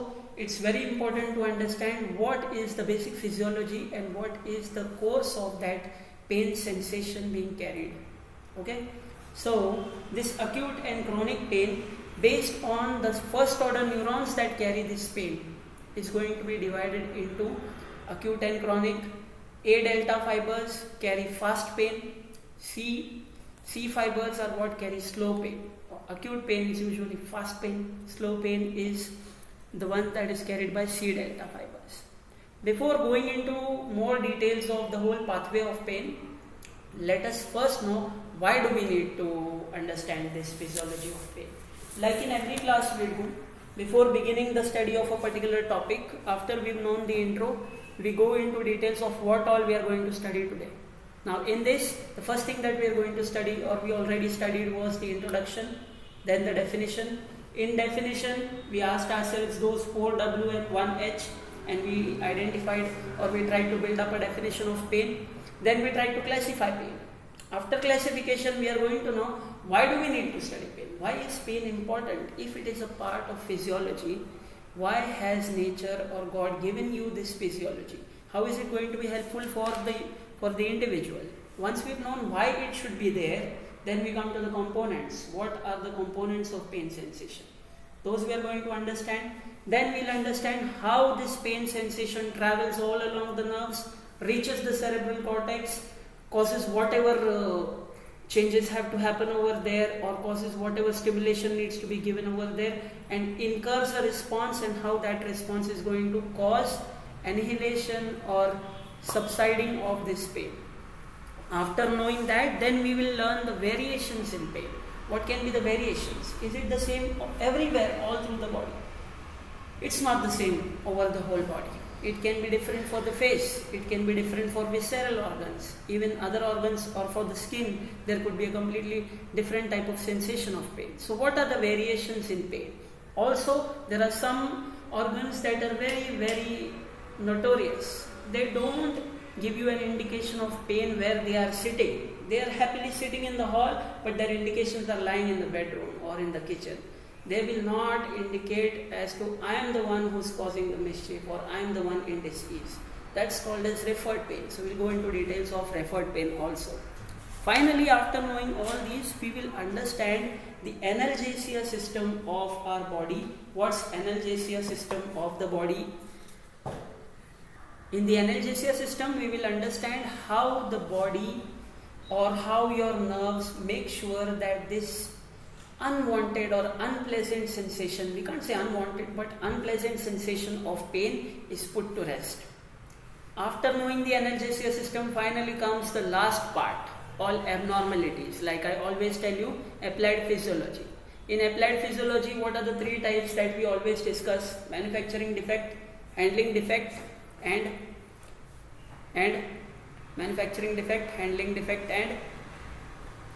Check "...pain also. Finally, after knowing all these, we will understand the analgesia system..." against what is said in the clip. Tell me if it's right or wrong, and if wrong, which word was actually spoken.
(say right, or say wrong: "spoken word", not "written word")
right.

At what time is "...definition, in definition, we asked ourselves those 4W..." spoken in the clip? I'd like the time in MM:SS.
00:56.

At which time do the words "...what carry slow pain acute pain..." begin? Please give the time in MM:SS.
00:24.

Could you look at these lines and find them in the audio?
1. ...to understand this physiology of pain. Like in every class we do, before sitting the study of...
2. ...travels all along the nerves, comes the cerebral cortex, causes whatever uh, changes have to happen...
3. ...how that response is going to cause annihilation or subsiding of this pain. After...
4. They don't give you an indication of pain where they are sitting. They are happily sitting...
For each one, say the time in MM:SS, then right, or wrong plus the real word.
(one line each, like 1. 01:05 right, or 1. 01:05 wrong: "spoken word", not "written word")
1. 00:39 wrong: "beginning", not "sitting"
2. 01:32 wrong: "reaches", not "comes"
3. 01:44 right
4. 02:18 right.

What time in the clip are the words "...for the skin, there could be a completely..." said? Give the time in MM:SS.
02:07.